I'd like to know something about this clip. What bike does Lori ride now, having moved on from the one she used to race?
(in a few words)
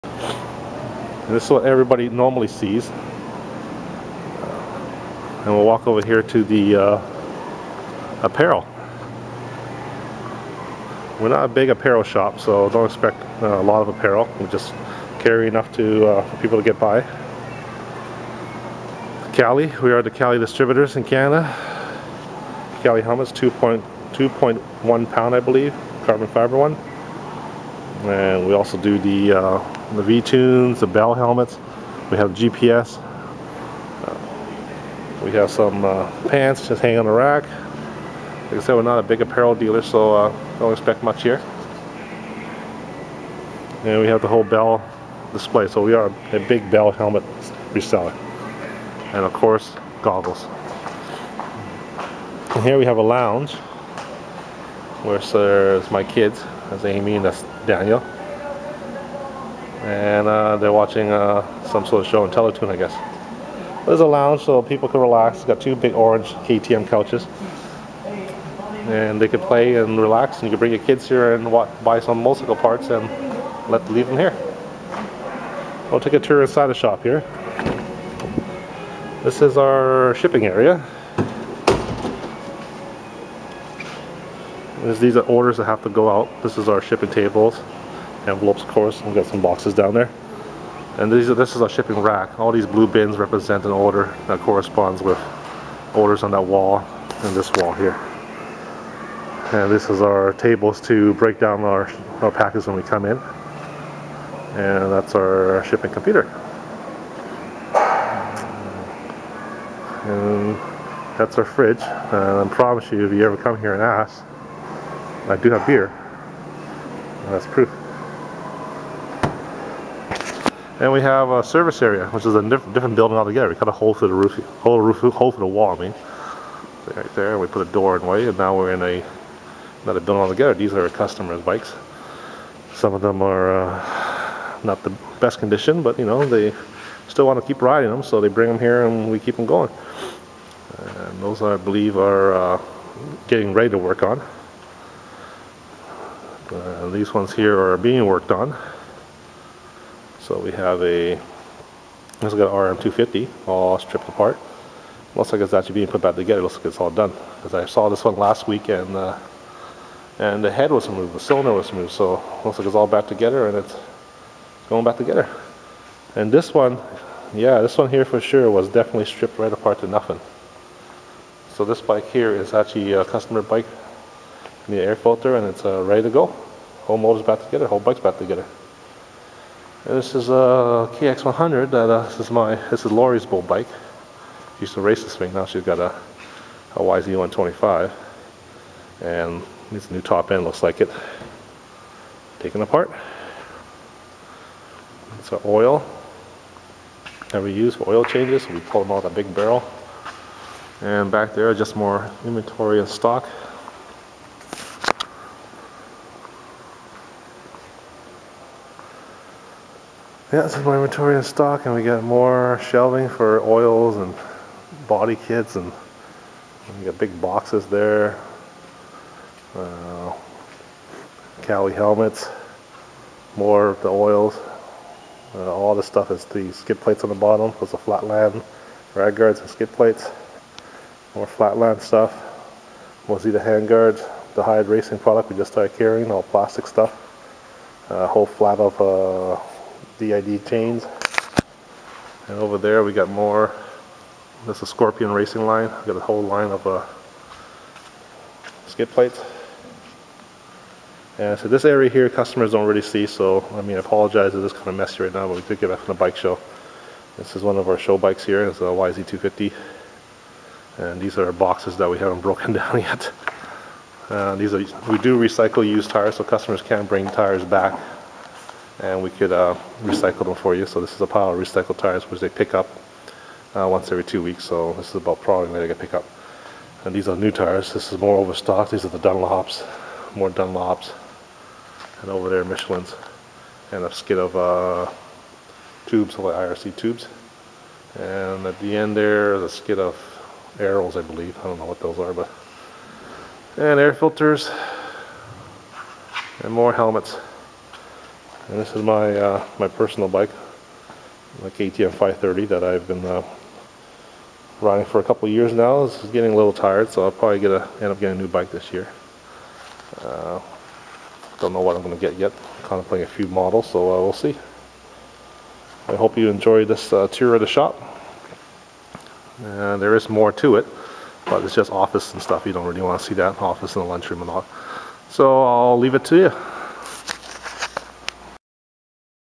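YZ125.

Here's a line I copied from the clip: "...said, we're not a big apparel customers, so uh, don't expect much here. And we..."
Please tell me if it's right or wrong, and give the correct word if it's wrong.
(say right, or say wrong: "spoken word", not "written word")
wrong: "dealer", not "customers".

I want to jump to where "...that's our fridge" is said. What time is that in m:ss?
1:51.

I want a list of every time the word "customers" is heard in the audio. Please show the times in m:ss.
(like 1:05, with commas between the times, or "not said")
2:10, 2:53, 4:12, 4:26.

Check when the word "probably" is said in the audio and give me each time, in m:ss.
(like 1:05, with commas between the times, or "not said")
4:35, 5:07.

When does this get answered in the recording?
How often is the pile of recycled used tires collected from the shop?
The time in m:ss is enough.
4:33.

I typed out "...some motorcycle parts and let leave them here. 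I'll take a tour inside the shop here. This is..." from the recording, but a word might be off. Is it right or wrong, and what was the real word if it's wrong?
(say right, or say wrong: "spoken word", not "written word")
right.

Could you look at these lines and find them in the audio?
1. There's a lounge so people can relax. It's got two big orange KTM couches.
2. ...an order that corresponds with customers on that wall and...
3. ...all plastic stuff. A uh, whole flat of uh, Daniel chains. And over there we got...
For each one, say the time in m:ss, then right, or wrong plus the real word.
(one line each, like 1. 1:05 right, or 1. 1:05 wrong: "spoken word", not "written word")
1. 1:03 right
2. 1:33 wrong: "orders", not "customers"
3. 3:56 wrong: "DID", not "Daniel".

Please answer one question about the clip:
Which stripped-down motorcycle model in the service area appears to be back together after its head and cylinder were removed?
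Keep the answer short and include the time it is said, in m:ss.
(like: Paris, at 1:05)
RM250, at 2:32.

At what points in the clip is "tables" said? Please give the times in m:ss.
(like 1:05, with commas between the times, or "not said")
1:27, 1:40.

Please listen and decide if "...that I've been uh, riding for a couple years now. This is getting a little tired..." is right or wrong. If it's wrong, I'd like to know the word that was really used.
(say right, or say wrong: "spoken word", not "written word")
right.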